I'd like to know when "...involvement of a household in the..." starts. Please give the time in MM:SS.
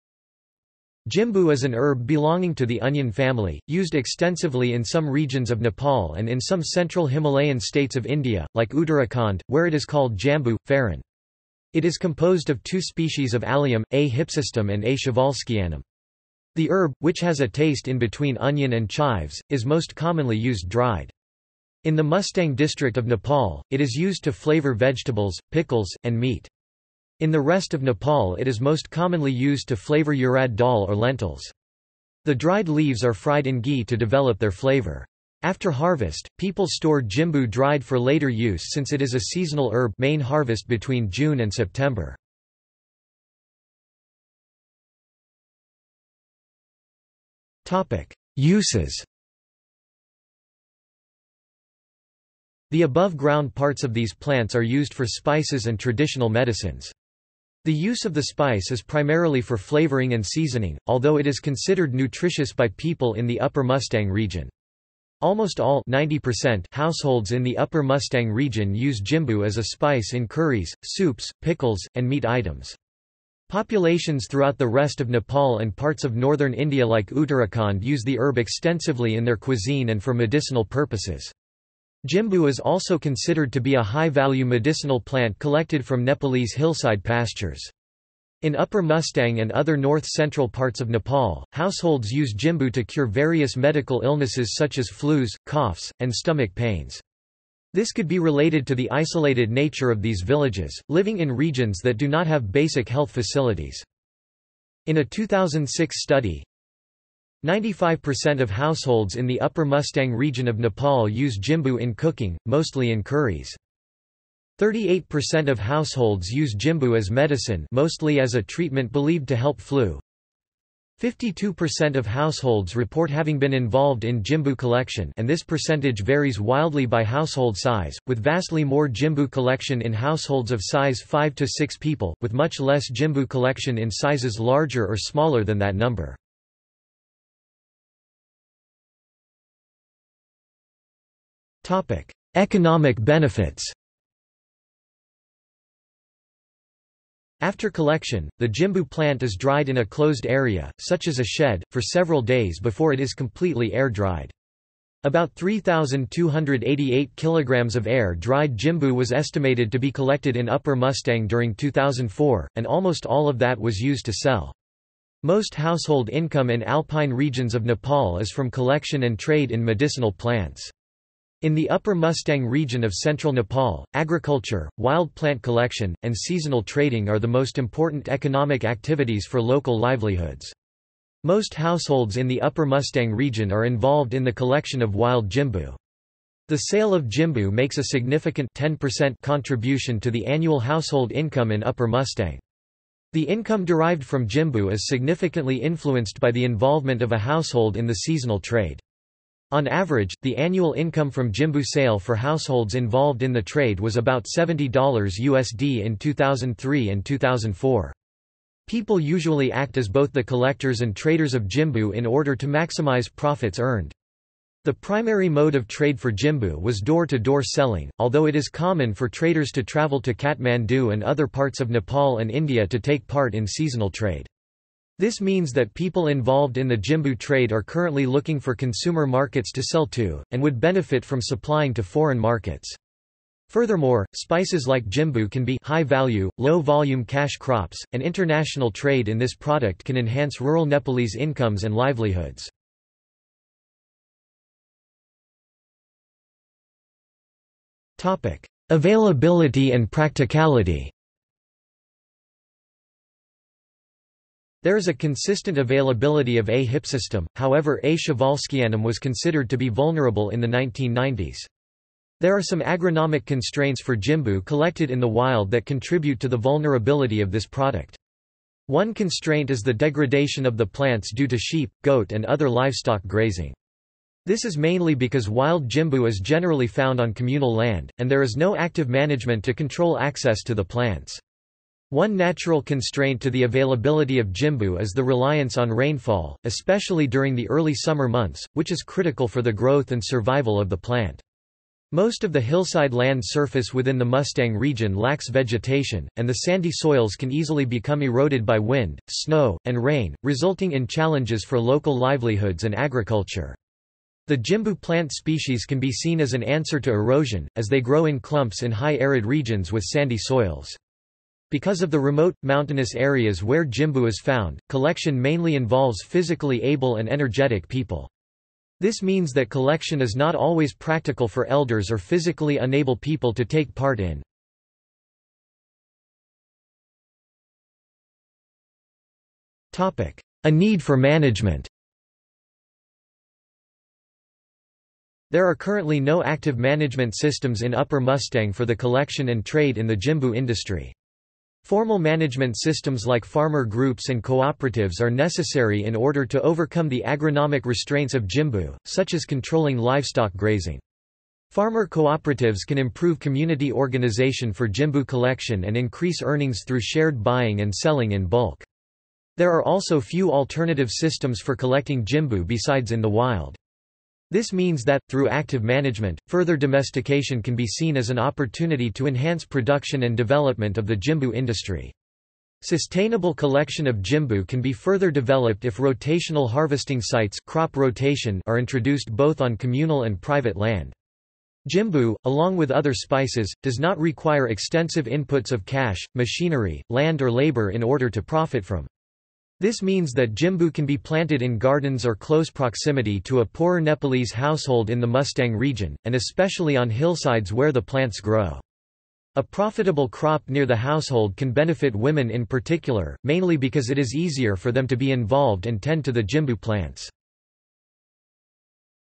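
03:16.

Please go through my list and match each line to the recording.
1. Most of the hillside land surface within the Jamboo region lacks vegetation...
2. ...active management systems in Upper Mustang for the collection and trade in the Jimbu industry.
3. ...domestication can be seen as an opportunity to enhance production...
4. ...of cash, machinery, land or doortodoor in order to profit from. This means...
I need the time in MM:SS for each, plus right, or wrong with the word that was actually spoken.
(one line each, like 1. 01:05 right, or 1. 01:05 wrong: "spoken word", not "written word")
1. 04:51 wrong: "Mustang", not "Jamboo"
2. 05:36 right
3. 06:06 right
4. 06:25 wrong: "labor", not "doortodoor".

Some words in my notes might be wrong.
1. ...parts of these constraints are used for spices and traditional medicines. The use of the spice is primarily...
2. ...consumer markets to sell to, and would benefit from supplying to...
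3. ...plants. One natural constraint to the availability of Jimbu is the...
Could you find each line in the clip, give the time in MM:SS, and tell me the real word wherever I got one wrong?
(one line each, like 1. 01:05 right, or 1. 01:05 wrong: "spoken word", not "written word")
1. 00:53 wrong: "plants", not "constraints"
2. 03:48 right
3. 04:40 right.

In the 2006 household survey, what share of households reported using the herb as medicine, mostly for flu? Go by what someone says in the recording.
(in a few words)
38%.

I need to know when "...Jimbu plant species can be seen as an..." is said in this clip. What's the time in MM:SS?
05:04.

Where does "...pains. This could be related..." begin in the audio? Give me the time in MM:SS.
01:36.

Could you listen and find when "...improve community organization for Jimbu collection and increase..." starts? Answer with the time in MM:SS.
05:52.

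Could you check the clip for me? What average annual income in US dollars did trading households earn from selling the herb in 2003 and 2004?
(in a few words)
$70.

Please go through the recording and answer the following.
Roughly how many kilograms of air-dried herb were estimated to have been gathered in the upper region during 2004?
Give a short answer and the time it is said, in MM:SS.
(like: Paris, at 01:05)
3,288, at 02:35.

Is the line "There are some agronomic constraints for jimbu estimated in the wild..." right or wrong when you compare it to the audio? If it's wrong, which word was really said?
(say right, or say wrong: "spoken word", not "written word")
wrong: "collected", not "estimated".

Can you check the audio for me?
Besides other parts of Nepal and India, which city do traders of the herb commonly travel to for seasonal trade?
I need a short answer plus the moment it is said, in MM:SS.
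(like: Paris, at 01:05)
Kathmandu, at 03:40.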